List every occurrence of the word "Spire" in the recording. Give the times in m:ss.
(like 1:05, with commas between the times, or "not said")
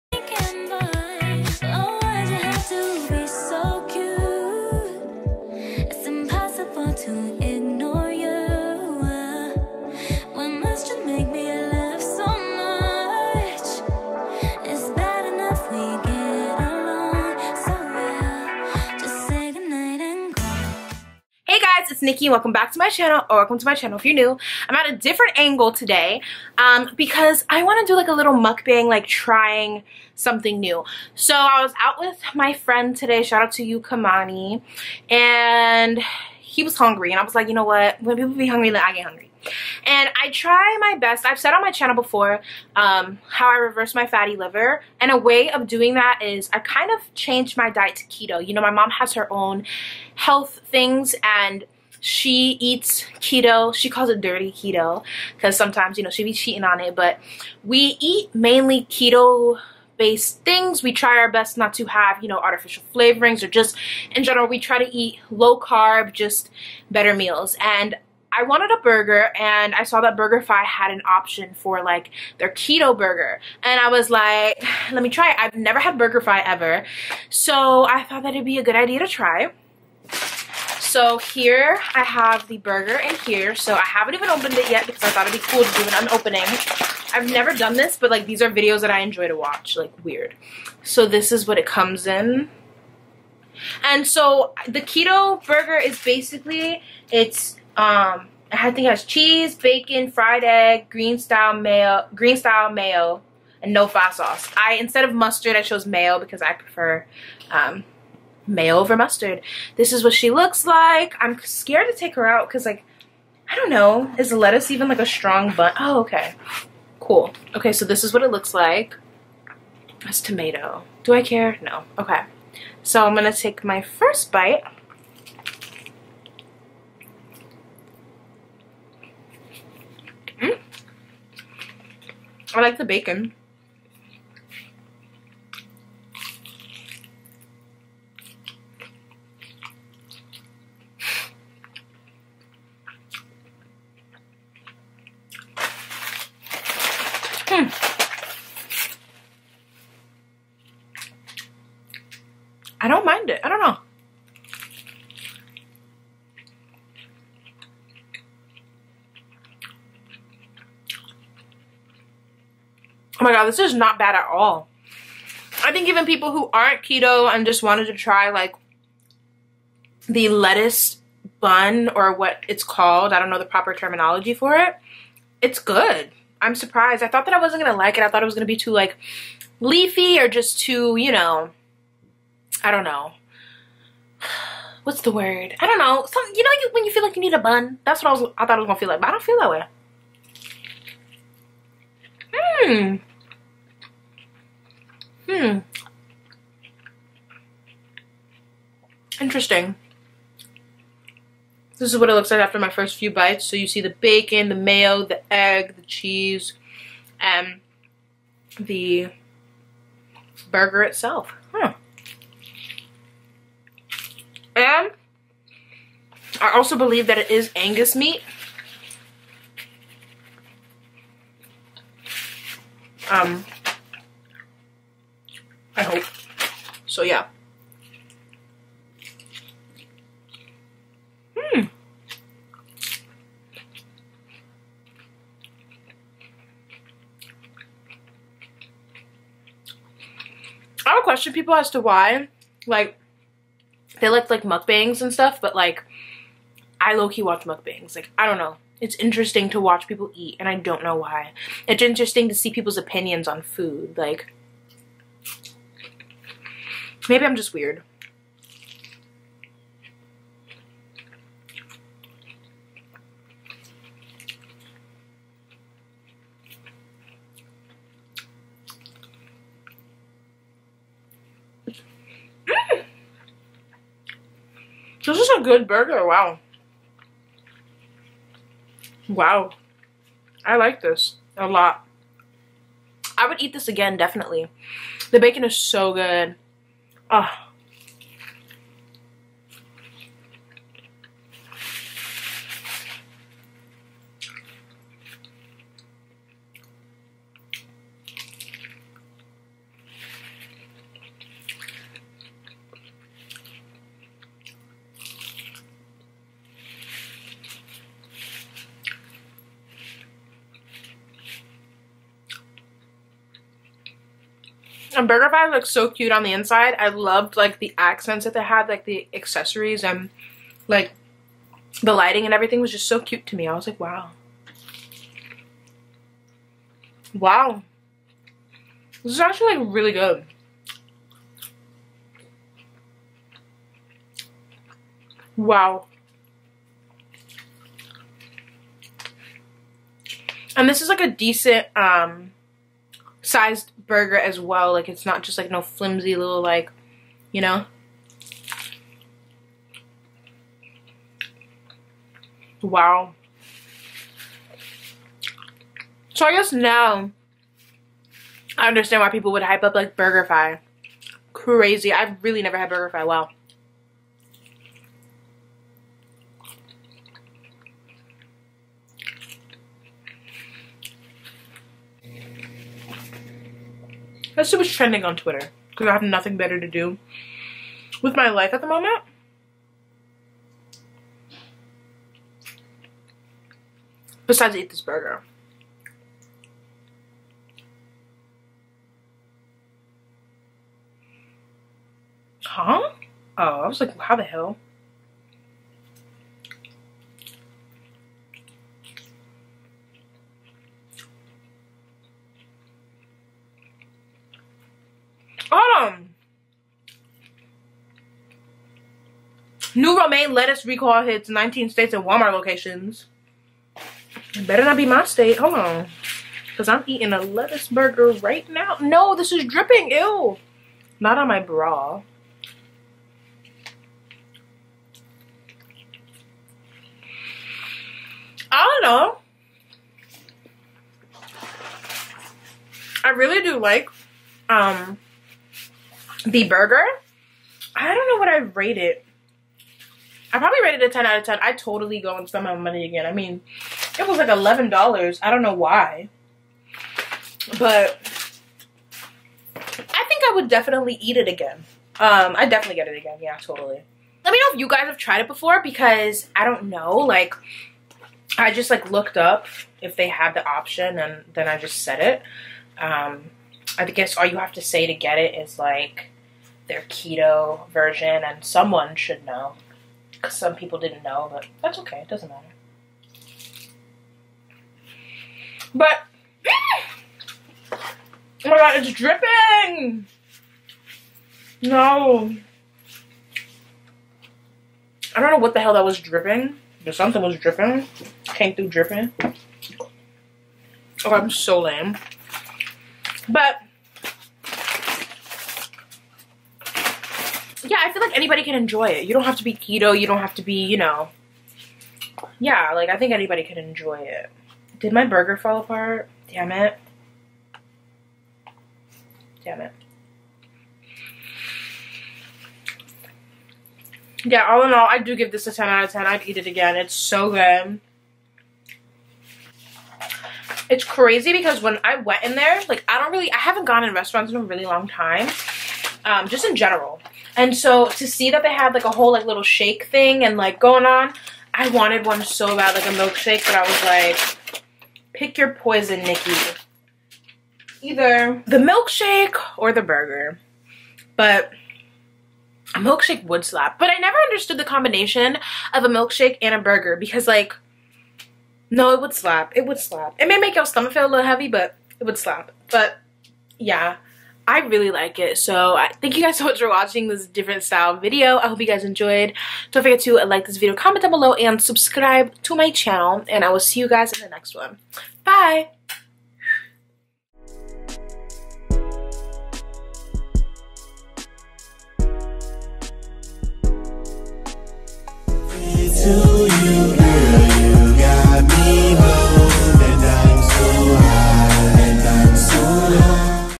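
not said.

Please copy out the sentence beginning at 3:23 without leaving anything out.
So you see the bacon, the mayo, the egg, the cheese, and um, the burger itself.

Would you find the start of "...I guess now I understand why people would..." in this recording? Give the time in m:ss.
5:56.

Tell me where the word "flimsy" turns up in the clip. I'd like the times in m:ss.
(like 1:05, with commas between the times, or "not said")
5:45.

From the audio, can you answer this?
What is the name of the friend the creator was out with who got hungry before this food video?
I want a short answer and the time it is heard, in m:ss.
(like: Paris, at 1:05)
Kymani, at 0:33.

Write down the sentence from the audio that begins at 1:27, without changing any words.
I've never done this, but like these are videos that I enjoy to watch, like weird.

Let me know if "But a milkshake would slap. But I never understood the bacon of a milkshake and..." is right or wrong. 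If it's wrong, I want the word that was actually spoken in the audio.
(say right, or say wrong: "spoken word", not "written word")
wrong: "combination", not "bacon".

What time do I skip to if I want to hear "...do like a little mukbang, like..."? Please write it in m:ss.
0:27.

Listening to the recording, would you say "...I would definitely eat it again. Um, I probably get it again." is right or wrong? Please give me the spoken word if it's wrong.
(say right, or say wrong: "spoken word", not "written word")
wrong: "definitely", not "probably".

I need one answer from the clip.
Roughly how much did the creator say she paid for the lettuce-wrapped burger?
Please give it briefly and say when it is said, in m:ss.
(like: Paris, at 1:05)
$11, at 7:24.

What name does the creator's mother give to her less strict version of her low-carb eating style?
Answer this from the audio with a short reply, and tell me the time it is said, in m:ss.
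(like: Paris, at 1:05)
dirty keto, at 0:54.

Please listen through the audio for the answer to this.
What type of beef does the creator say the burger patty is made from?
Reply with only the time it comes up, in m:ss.
3:37.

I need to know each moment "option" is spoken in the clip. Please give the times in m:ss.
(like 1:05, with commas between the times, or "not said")
1:11, 7:40.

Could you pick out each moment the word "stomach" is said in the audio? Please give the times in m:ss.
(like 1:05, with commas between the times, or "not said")
9:10.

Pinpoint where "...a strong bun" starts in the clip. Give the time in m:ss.
1:54.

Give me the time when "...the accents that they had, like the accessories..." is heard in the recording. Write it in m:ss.
5:17.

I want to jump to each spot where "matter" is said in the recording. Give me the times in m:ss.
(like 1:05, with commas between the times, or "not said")
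7:52.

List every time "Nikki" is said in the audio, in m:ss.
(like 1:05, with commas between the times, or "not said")
0:22, 8:56.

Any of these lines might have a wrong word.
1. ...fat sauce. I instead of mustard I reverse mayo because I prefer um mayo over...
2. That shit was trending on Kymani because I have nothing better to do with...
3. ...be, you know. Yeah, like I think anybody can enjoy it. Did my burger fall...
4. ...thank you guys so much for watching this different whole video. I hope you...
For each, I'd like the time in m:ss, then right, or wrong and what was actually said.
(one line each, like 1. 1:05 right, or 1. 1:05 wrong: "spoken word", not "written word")
1. 1:43 wrong: "chose", not "reverse"
2. 6:14 wrong: "Twitter", not "Kymani"
3. 8:20 right
4. 9:16 wrong: "style", not "whole".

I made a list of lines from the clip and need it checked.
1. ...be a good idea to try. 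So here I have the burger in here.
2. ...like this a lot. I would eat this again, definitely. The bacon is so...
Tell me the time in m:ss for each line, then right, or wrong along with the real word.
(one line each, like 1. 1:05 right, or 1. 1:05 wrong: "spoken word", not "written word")
1. 1:18 right
2. 4:40 right.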